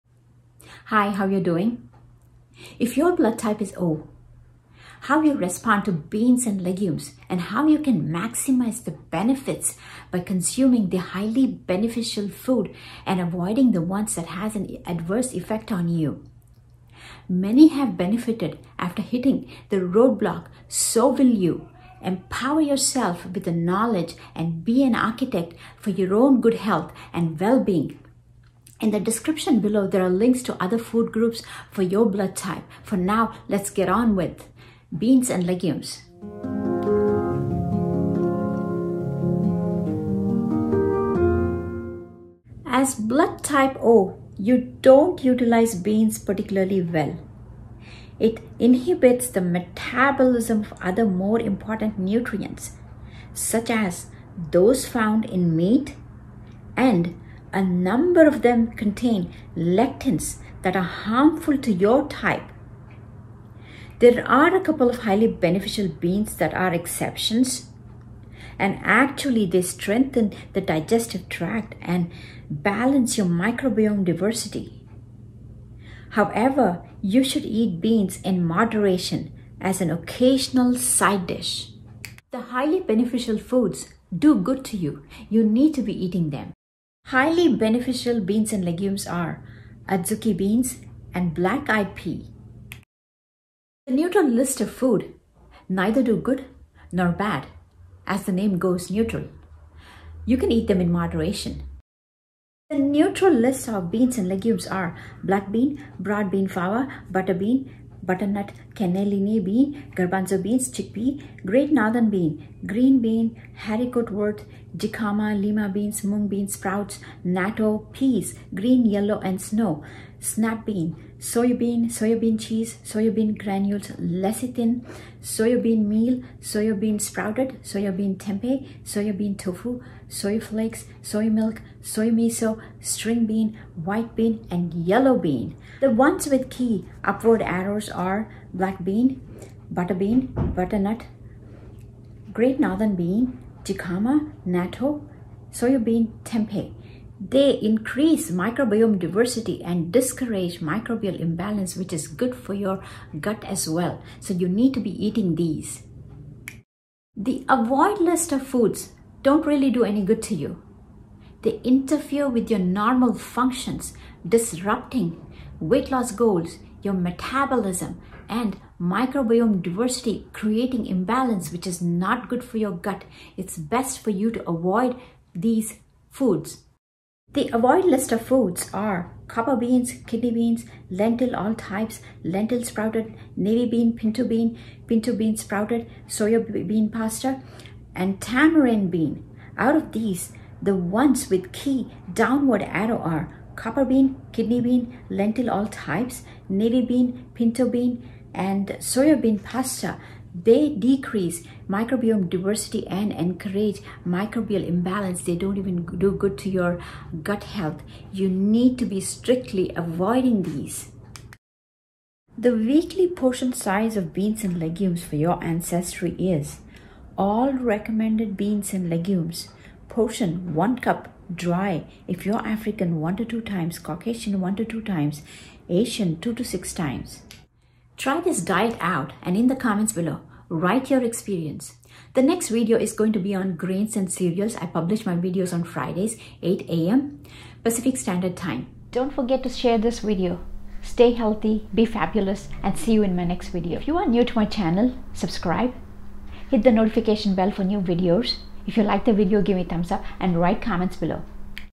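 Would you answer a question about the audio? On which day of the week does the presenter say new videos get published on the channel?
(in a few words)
Fridays.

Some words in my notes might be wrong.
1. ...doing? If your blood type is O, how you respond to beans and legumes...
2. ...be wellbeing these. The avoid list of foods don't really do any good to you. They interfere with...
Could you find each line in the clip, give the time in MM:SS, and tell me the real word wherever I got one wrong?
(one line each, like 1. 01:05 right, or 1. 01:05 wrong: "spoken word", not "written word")
1. 00:01 right
2. 02:34 wrong: "eating", not "wellbeing".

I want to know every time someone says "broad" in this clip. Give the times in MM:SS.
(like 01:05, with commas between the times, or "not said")
01:45.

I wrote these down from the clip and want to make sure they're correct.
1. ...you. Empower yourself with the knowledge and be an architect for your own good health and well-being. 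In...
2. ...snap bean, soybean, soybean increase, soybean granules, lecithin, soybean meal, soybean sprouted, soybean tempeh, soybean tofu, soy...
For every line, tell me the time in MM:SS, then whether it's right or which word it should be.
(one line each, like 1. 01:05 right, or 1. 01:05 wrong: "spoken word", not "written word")
1. 00:21 right
2. 02:00 wrong: "cheese", not "increase".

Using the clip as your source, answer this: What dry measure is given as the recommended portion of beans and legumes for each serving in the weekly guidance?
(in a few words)
One cup dry.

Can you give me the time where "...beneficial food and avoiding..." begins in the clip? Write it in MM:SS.
00:11.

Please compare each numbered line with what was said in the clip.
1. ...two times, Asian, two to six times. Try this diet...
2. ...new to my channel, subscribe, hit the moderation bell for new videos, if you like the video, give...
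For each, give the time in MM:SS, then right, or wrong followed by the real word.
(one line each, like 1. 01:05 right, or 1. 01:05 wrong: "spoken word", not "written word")
1. 03:44 right
2. 04:04 wrong: "notification", not "moderation".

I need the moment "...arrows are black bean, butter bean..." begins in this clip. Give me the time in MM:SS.
02:17.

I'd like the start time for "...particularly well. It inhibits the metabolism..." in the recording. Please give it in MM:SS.
00:46.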